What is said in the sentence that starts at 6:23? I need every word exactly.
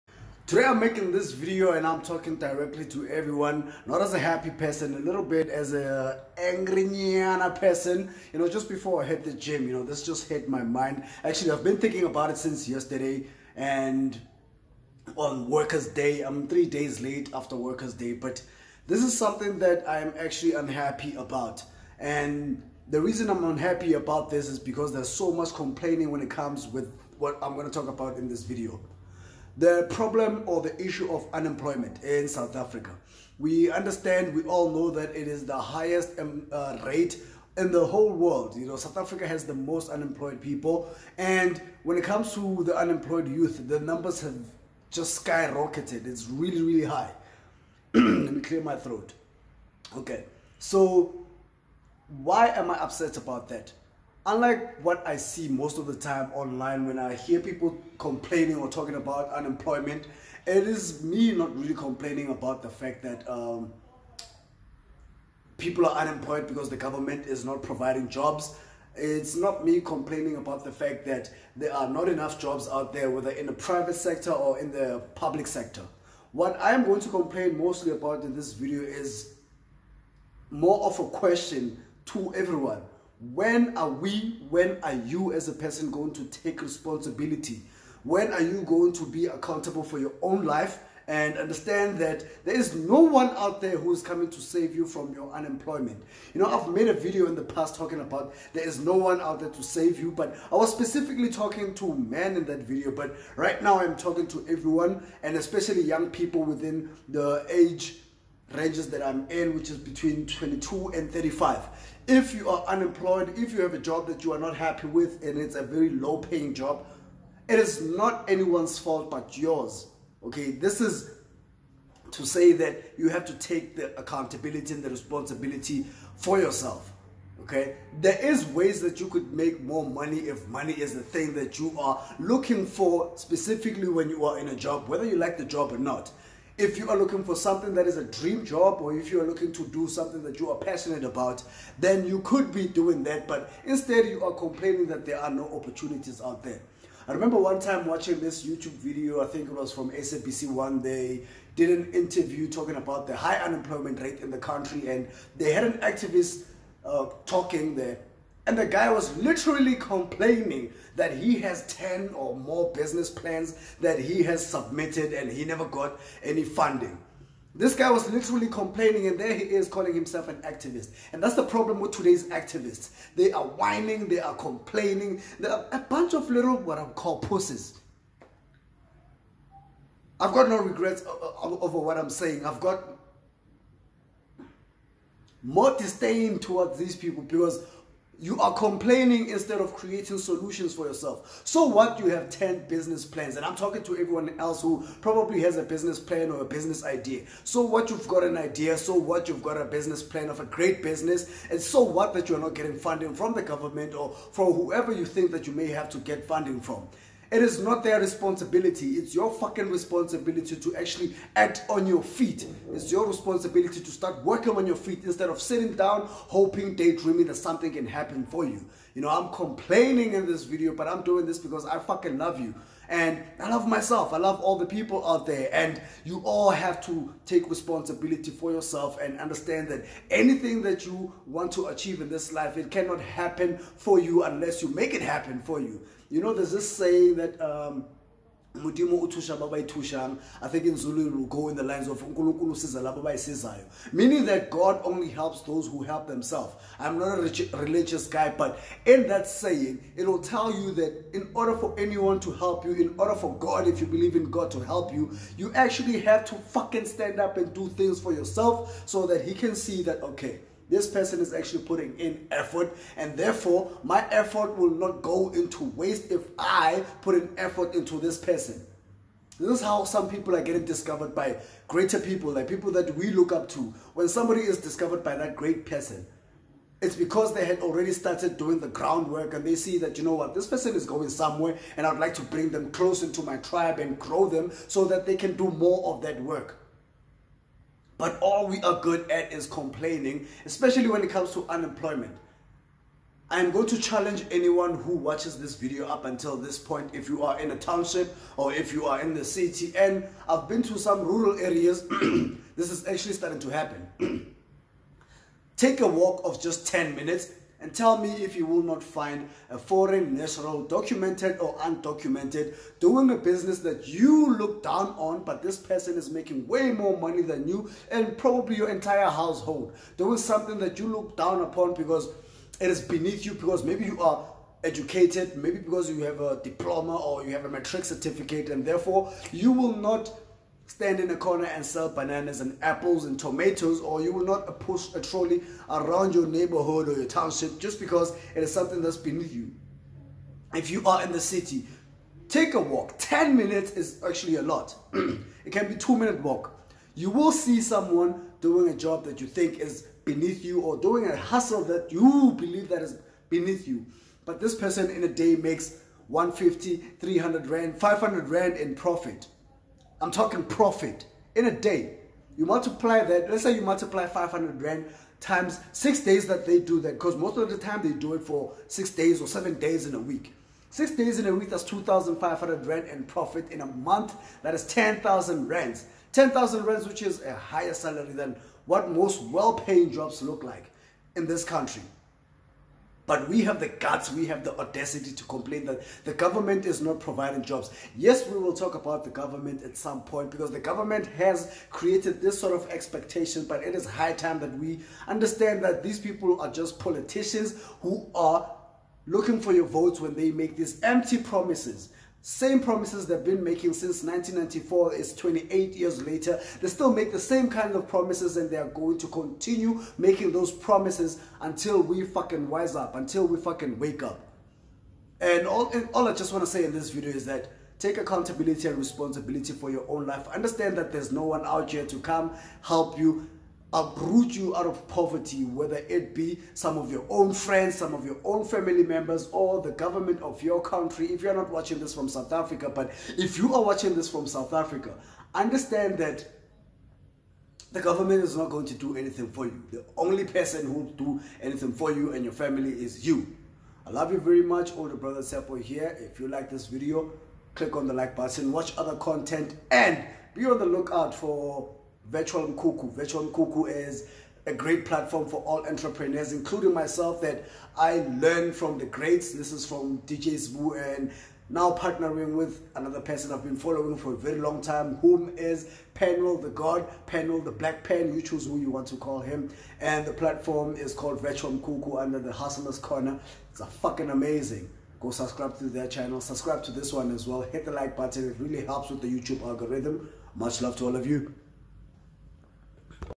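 But we have the guts, we have the audacity to complain that the government is not providing jobs.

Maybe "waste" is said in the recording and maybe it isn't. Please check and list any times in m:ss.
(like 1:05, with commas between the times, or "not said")
4:25.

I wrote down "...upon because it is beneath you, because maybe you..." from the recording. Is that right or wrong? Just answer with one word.
right.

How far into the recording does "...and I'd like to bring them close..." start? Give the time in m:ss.
4:41.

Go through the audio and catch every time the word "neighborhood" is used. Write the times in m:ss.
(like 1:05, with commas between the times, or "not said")
5:36.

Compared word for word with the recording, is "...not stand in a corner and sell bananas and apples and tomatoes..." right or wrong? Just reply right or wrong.
right.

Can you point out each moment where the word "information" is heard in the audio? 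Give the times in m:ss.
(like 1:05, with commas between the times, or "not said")
not said.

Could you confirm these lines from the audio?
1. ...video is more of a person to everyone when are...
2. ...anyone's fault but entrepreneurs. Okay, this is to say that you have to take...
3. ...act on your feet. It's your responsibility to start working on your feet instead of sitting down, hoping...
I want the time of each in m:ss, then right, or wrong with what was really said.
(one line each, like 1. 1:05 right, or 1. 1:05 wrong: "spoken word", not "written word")
1. 1:18 wrong: "question", not "person"
2. 1:58 wrong: "yours", not "entrepreneurs"
3. 3:31 right.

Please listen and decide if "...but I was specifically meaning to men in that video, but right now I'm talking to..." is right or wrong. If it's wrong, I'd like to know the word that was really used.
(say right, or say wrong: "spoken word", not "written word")
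wrong: "talking", not "meaning".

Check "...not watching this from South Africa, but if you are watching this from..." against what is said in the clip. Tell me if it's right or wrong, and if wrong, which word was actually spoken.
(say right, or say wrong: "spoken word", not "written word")
right.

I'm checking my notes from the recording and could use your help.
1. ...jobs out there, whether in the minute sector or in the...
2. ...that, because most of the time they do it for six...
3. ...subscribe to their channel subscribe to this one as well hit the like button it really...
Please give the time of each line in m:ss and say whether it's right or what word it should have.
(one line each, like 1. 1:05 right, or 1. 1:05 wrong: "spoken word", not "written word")
1. 1:12 wrong: "private", not "minute"
2. 6:06 right
3. 7:55 right.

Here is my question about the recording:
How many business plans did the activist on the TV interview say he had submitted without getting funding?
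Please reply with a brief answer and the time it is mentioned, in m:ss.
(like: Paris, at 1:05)
10 or more, at 2:41.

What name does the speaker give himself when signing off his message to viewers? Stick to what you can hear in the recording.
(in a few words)
Tshepo.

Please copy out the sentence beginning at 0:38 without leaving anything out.
You know, South Africa has the most unemployed people.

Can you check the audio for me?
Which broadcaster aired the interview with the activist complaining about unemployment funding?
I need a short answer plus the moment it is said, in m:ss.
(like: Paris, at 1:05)
SABC One, at 2:29.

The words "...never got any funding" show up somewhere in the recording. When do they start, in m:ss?
2:45.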